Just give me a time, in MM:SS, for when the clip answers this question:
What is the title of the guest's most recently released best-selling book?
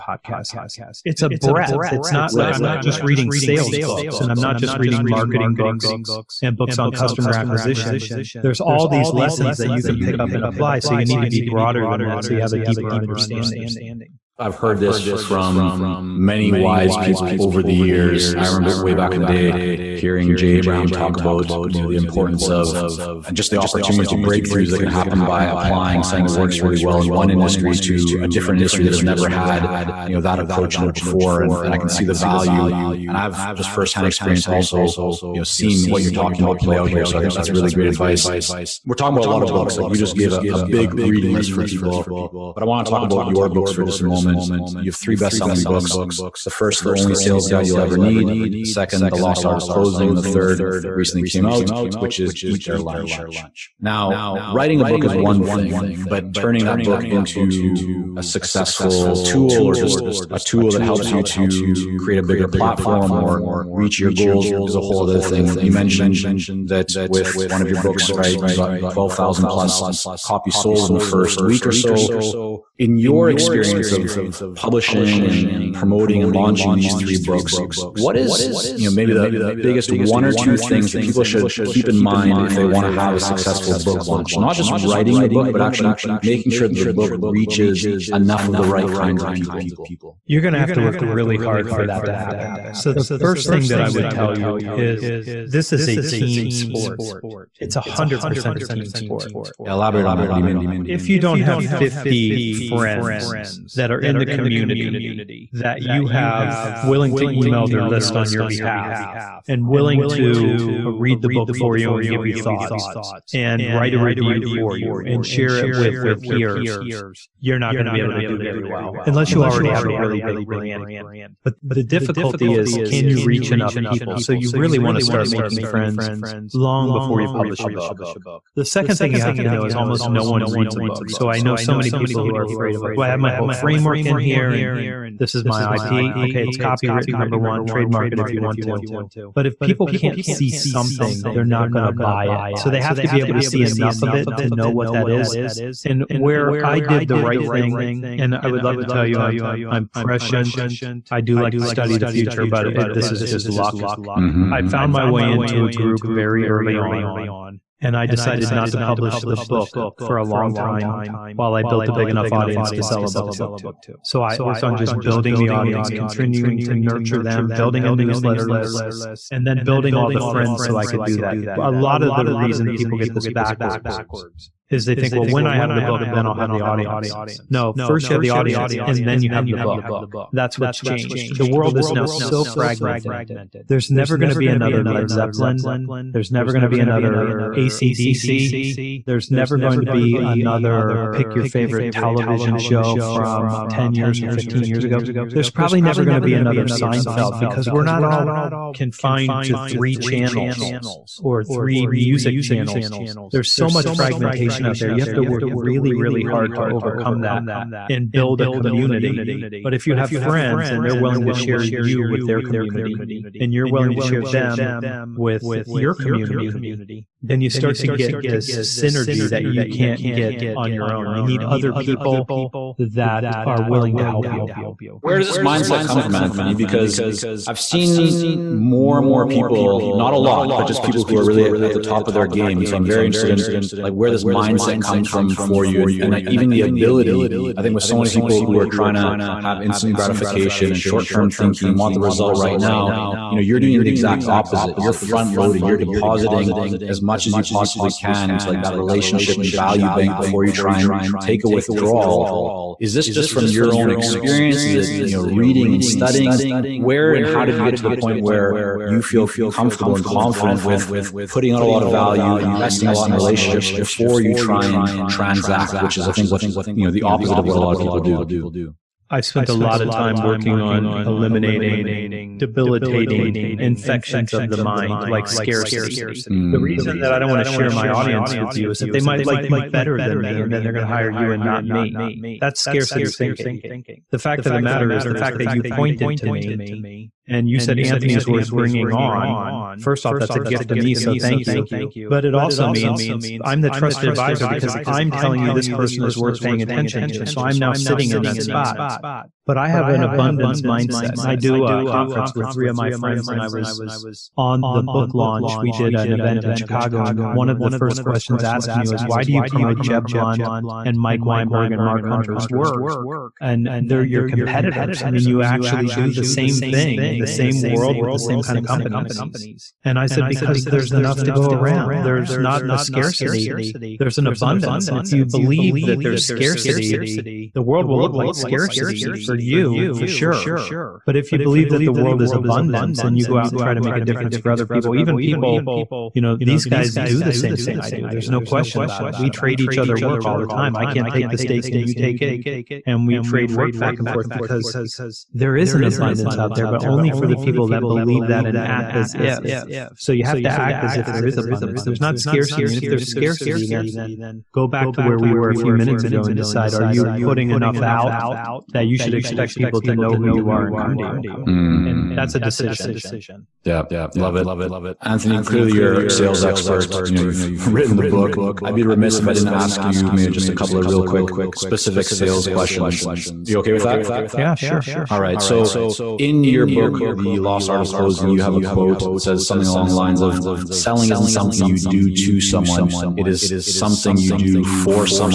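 00:52.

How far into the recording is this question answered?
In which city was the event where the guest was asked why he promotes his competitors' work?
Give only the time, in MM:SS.
05:06.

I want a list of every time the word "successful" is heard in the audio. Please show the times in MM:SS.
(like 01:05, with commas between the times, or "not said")
00:58, 01:23.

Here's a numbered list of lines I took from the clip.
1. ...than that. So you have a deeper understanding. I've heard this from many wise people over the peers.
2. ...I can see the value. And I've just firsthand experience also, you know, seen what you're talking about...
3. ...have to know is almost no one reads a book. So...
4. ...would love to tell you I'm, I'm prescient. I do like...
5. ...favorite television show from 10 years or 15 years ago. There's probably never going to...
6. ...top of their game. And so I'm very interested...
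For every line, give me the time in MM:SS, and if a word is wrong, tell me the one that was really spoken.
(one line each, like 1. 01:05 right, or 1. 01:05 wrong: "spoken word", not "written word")
1. 00:11 wrong: "years", not "peers"
2. 00:31 right
3. 02:09 right
4. 02:28 right
5. 03:11 right
6. 03:51 right.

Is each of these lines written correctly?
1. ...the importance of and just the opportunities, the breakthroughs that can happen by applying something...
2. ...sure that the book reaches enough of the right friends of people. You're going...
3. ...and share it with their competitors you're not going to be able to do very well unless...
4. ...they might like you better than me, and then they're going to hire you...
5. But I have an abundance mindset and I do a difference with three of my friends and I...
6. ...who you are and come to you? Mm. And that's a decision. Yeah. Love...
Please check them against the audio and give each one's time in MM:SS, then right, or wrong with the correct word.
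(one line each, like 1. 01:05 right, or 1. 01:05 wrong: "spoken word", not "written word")
1. 00:21 right
2. 01:26 wrong: "kinds", not "friends"
3. 01:55 wrong: "peers", not "competitors"
4. 04:38 right
5. 04:59 wrong: "conference", not "difference"
6. 06:00 right.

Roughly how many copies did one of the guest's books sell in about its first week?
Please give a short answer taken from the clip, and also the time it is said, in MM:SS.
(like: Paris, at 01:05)
12,000, at 01:08.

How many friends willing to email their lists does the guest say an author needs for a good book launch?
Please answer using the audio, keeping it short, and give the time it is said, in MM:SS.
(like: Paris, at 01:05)
50, at 01:41.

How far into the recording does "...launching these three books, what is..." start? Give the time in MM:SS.
01:16.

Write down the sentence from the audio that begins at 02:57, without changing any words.
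No, first you have the audience and then you have the book.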